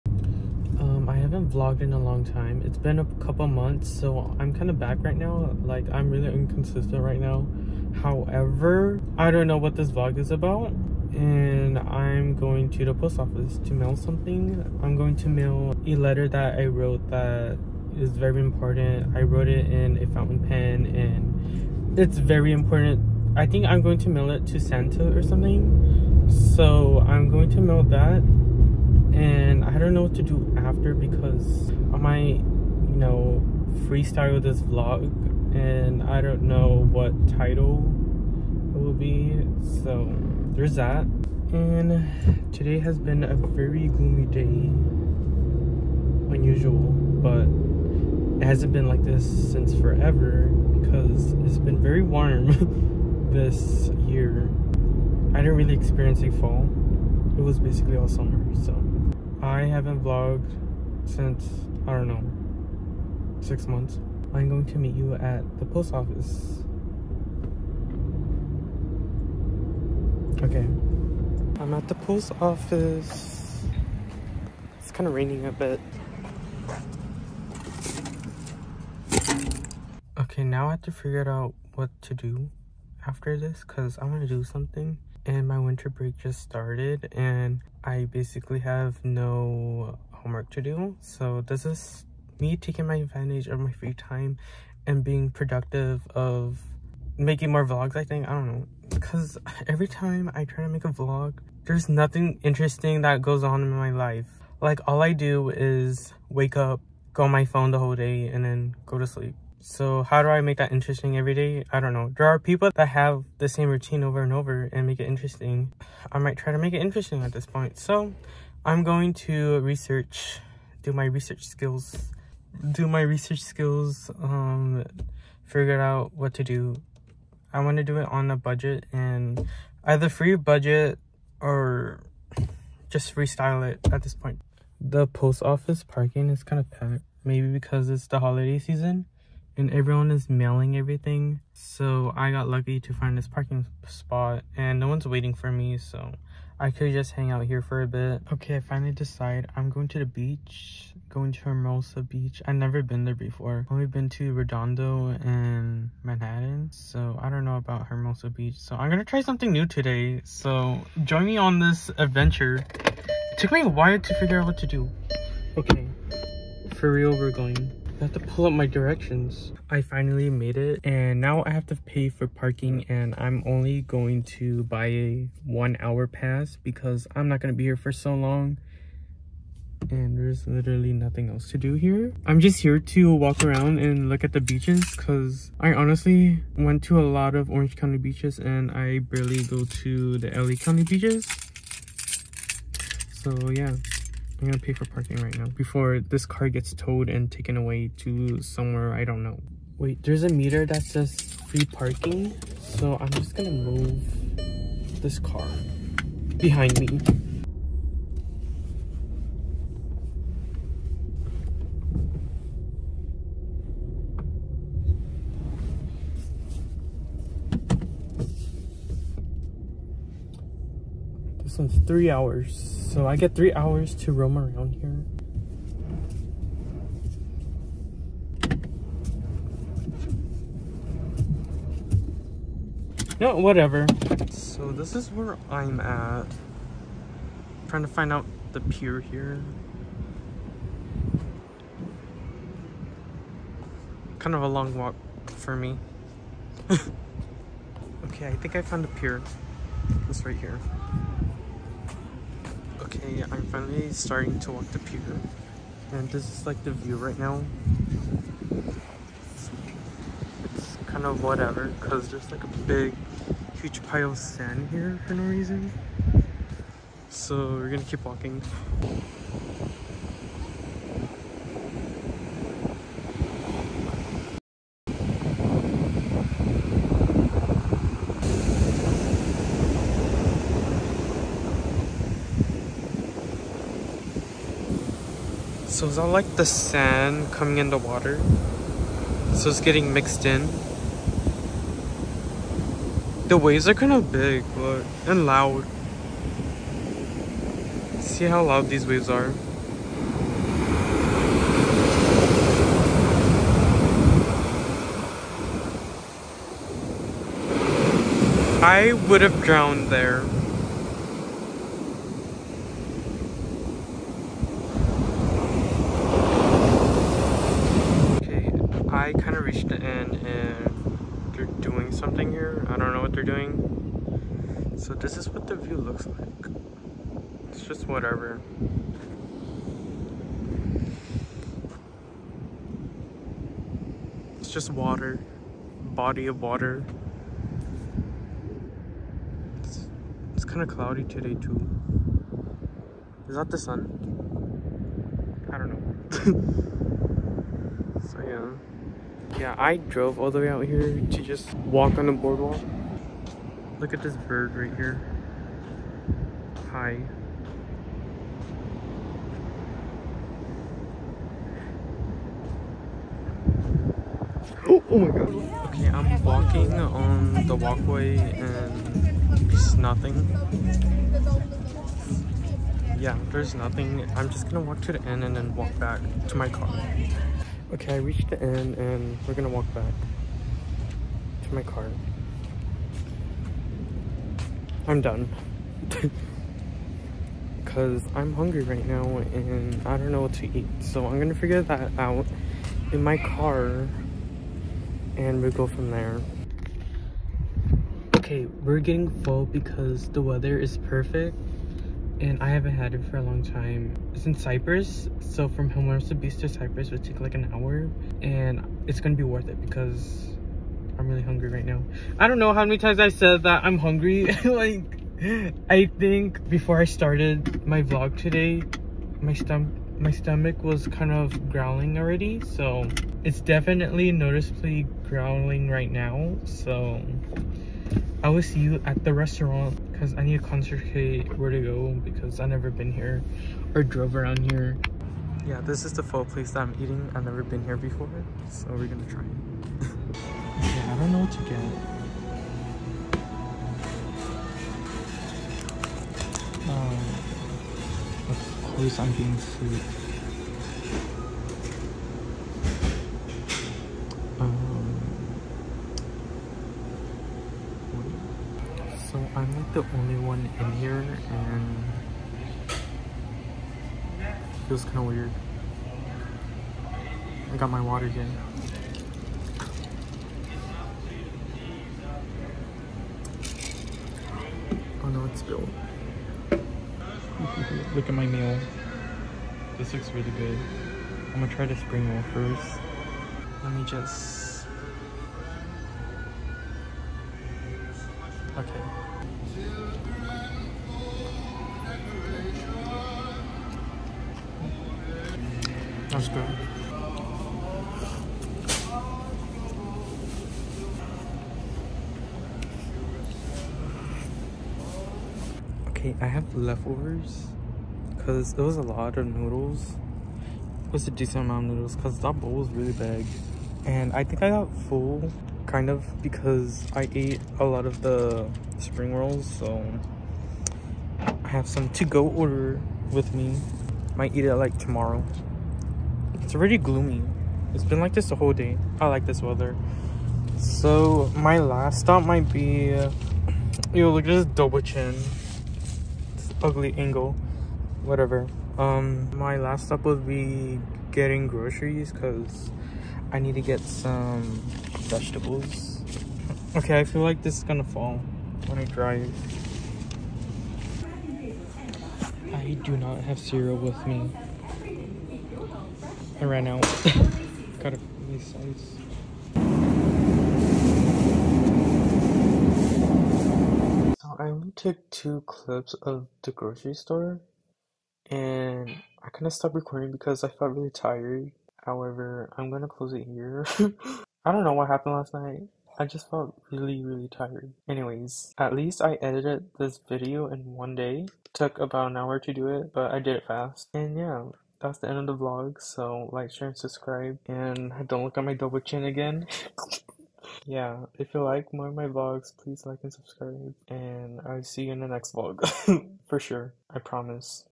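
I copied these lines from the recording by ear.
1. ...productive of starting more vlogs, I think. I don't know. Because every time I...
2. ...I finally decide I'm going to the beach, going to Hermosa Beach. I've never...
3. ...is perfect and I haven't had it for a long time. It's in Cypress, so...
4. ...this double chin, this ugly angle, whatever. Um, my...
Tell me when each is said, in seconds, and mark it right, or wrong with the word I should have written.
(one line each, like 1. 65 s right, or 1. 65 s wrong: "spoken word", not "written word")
1. 95 s wrong: "making", not "starting"
2. 148 s right
3. 400 s right
4. 534 s right.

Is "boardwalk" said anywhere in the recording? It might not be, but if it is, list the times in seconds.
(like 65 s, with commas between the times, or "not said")
352 s.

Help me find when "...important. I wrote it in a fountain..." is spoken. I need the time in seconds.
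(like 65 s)
18 s.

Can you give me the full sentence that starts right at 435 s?
Yeah, this is the pho place that I'm eating.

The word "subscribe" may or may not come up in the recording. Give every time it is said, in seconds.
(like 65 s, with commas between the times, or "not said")
586 s, 593 s.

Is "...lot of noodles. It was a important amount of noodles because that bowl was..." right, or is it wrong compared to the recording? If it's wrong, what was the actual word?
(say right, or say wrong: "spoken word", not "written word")
wrong: "decent", not "important".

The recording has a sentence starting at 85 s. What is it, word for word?
And my winter break just started and I basically have no homework to do.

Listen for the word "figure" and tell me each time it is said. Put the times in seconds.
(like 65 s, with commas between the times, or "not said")
80 s, 125 s, 164 s, 391 s.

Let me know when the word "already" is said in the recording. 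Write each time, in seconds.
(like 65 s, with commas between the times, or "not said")
421 s, 526 s.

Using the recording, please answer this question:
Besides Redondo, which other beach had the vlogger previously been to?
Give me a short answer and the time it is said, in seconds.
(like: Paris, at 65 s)
Manhattan, at 156 s.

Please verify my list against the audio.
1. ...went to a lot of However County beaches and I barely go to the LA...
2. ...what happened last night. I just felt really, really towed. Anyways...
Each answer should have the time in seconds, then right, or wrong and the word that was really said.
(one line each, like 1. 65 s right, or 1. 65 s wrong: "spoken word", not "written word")
1. 186 s wrong: "Orange", not "However"
2. 574 s wrong: "tired", not "towed".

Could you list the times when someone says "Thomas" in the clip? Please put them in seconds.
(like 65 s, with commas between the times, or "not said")
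not said.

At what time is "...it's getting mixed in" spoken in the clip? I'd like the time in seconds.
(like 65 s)
289 s.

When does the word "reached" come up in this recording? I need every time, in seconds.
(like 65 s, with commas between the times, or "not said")
319 s, 377 s.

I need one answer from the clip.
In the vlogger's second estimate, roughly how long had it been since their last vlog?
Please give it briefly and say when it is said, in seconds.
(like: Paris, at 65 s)
6 months, at 63 s.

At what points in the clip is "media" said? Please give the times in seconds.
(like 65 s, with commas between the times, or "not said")
not said.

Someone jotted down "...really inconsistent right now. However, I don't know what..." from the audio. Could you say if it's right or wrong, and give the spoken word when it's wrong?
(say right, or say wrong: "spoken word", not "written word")
right.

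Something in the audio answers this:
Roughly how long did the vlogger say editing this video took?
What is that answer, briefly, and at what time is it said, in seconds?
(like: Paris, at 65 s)
About an hour, at 581 s.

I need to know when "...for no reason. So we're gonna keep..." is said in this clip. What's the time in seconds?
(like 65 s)
265 s.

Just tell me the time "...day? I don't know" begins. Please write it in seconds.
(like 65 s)
111 s.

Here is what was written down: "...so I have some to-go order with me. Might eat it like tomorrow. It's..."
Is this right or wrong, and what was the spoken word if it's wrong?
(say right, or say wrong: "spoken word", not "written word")
right.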